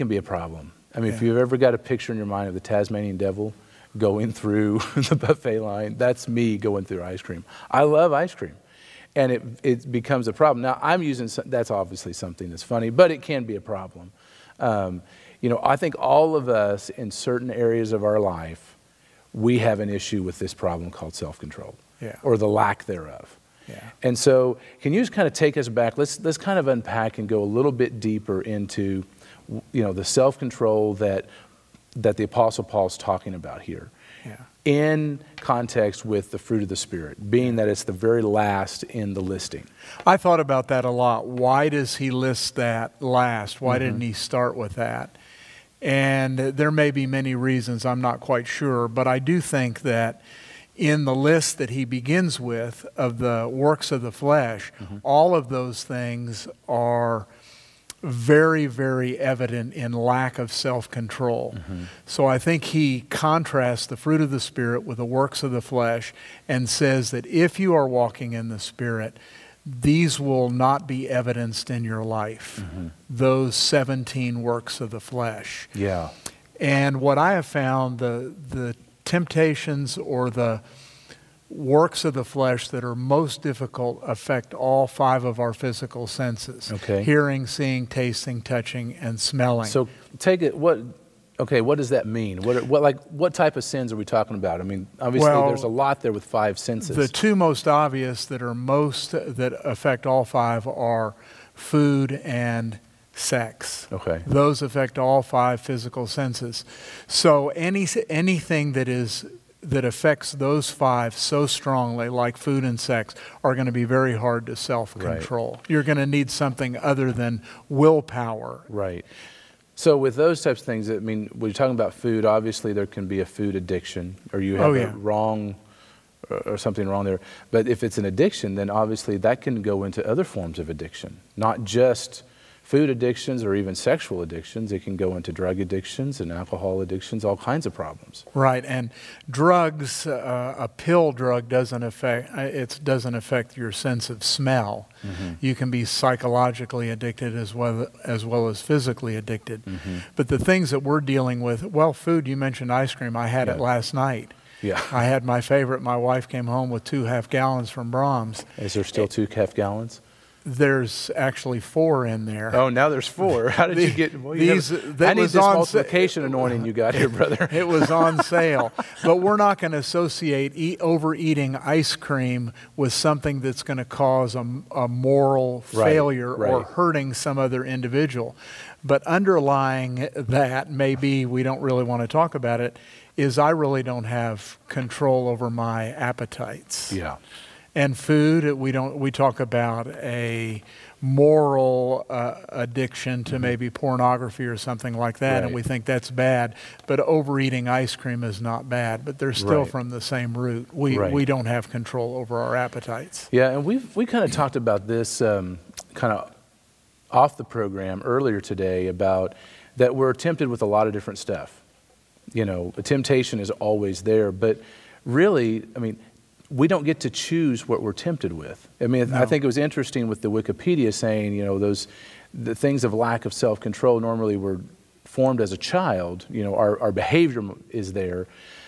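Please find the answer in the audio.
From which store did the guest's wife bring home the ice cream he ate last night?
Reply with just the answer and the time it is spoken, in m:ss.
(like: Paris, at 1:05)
Braum's, at 2:37.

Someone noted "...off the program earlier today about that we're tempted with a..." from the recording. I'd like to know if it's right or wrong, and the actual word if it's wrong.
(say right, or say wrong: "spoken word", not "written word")
right.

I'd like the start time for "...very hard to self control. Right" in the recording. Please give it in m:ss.
1:53.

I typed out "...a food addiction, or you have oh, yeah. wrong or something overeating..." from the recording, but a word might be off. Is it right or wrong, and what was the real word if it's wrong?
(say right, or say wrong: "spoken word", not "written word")
wrong: "wrong", not "overeating".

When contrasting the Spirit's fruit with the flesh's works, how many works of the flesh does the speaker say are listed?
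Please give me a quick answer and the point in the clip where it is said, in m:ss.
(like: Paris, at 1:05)
17, at 1:13.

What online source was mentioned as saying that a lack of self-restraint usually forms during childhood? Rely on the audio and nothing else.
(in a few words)
Wikipedia.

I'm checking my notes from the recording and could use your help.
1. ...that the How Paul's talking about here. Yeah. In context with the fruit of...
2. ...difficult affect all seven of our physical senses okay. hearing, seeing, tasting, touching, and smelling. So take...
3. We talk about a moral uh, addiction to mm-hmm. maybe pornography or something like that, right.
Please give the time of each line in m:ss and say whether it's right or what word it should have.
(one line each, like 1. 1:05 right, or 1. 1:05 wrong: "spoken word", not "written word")
1. 0:31 wrong: "Apostle", not "How"
2. 1:23 wrong: "five", not "seven"
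3. 3:08 right.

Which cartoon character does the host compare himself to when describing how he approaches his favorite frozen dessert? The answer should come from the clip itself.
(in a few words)
Tasmanian devil.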